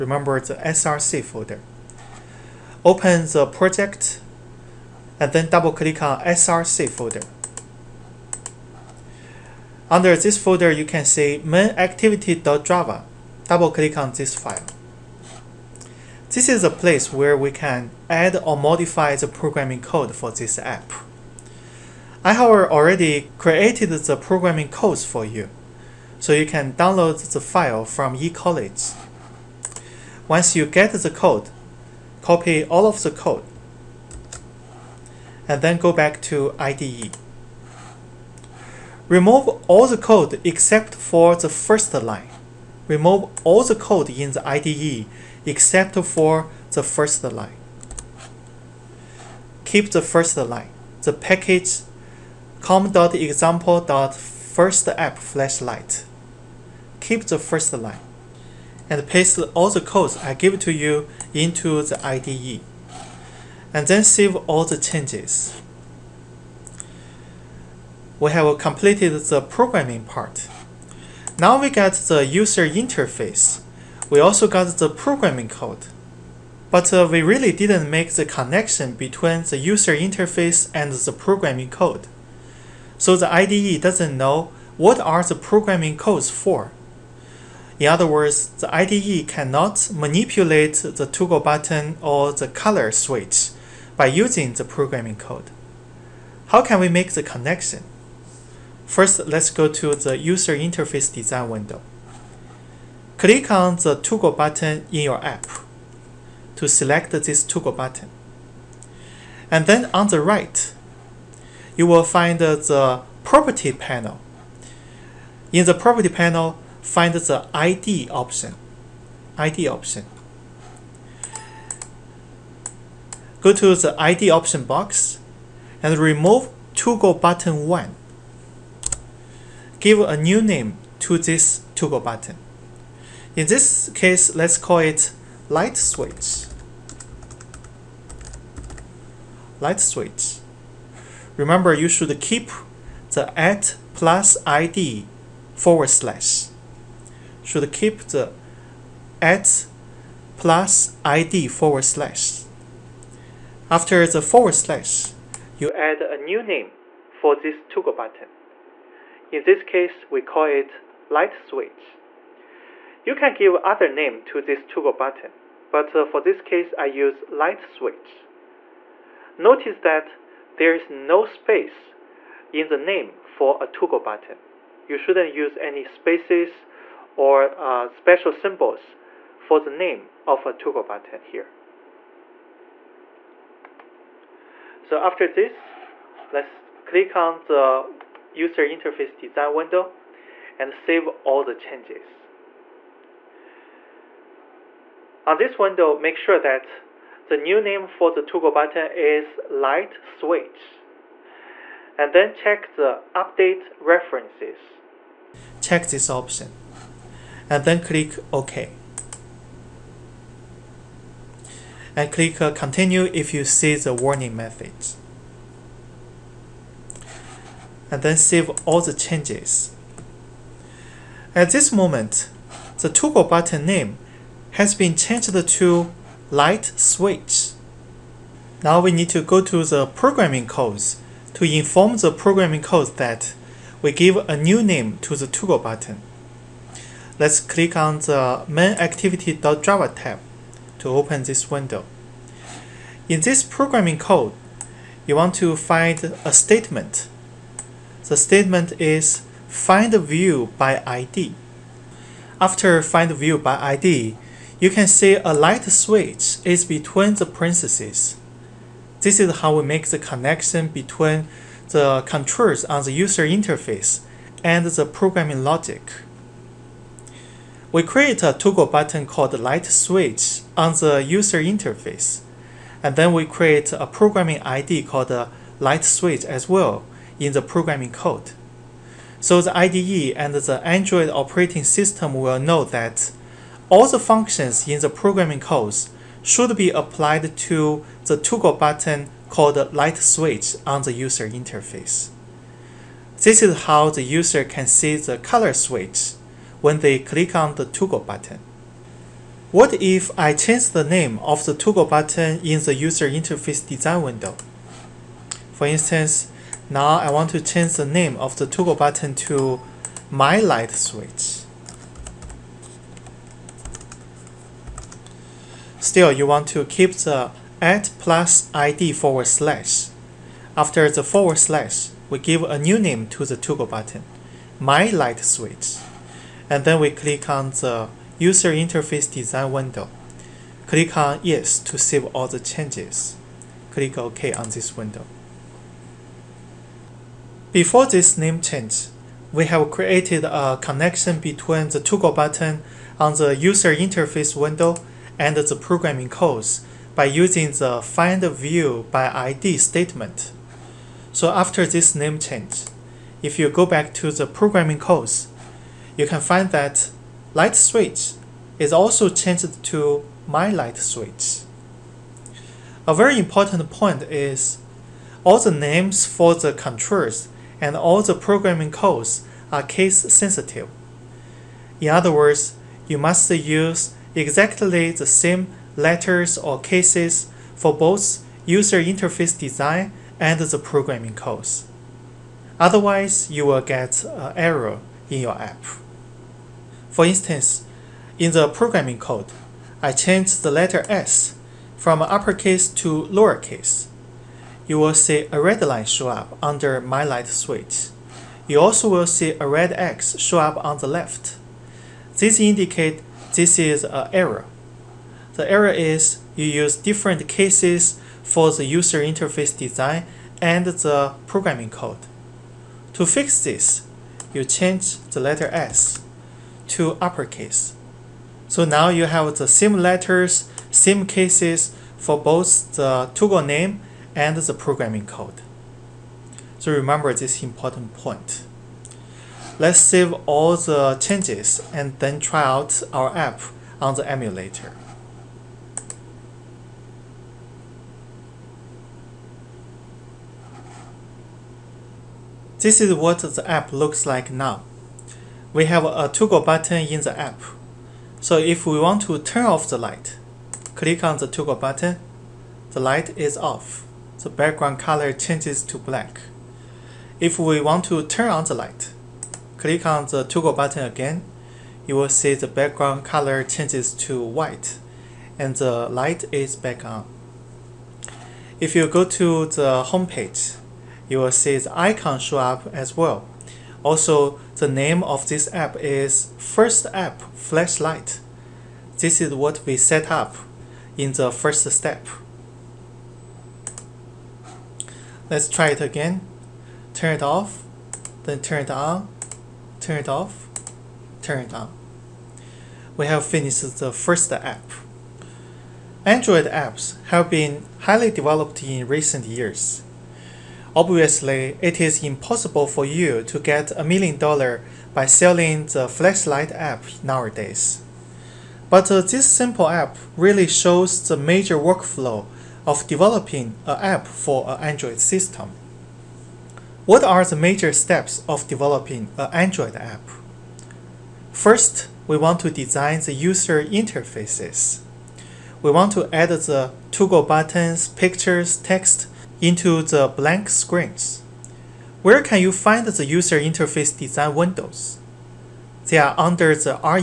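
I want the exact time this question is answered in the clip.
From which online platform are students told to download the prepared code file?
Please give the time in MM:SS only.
00:28.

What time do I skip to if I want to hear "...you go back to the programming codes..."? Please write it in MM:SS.
05:53.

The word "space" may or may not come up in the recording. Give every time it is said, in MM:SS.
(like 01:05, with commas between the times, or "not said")
02:51, 02:55.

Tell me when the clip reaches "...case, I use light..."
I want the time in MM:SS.
02:46.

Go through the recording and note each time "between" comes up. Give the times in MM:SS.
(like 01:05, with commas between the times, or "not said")
01:18, 04:16, 04:20, 05:41.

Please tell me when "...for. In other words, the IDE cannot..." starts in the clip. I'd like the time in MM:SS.
01:26.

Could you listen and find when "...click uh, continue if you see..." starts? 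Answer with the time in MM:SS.
03:32.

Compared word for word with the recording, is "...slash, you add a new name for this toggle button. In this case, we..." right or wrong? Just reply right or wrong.
right.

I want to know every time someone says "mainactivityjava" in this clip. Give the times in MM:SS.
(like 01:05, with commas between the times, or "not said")
00:11, 03:58.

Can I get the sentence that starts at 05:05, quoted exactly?
For instance, now I want to change the name of the toggle button to my light switch.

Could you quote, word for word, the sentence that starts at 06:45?
The error is you use different cases for the user interface design and the programming code.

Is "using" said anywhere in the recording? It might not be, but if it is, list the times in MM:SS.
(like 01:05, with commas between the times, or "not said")
01:34, 05:47.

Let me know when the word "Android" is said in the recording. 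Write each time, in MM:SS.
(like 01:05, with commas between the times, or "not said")
04:40, 08:16, 08:34, 08:39.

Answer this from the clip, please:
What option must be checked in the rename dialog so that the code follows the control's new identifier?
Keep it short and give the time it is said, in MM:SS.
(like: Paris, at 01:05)
update references, at 03:23.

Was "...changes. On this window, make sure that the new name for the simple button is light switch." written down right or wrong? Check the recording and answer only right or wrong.
wrong.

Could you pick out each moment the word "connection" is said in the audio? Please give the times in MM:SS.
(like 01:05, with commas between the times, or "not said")
01:18, 01:37, 04:19, 05:40.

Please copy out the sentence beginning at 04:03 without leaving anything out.
In this programming code, you want to find a statement.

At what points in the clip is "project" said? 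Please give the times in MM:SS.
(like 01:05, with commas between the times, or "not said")
00:03.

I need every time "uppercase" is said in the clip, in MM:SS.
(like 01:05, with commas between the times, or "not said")
06:32, 06:57.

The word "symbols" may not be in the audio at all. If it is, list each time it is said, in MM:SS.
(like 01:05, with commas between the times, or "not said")
02:58.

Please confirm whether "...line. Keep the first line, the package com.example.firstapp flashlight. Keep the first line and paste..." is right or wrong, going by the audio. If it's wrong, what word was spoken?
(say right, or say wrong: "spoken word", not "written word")
right.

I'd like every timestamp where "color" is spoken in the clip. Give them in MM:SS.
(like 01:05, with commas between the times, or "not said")
01:32, 04:55, 07:34, 07:43.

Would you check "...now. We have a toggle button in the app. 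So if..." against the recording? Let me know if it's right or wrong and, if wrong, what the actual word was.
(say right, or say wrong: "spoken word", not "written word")
right.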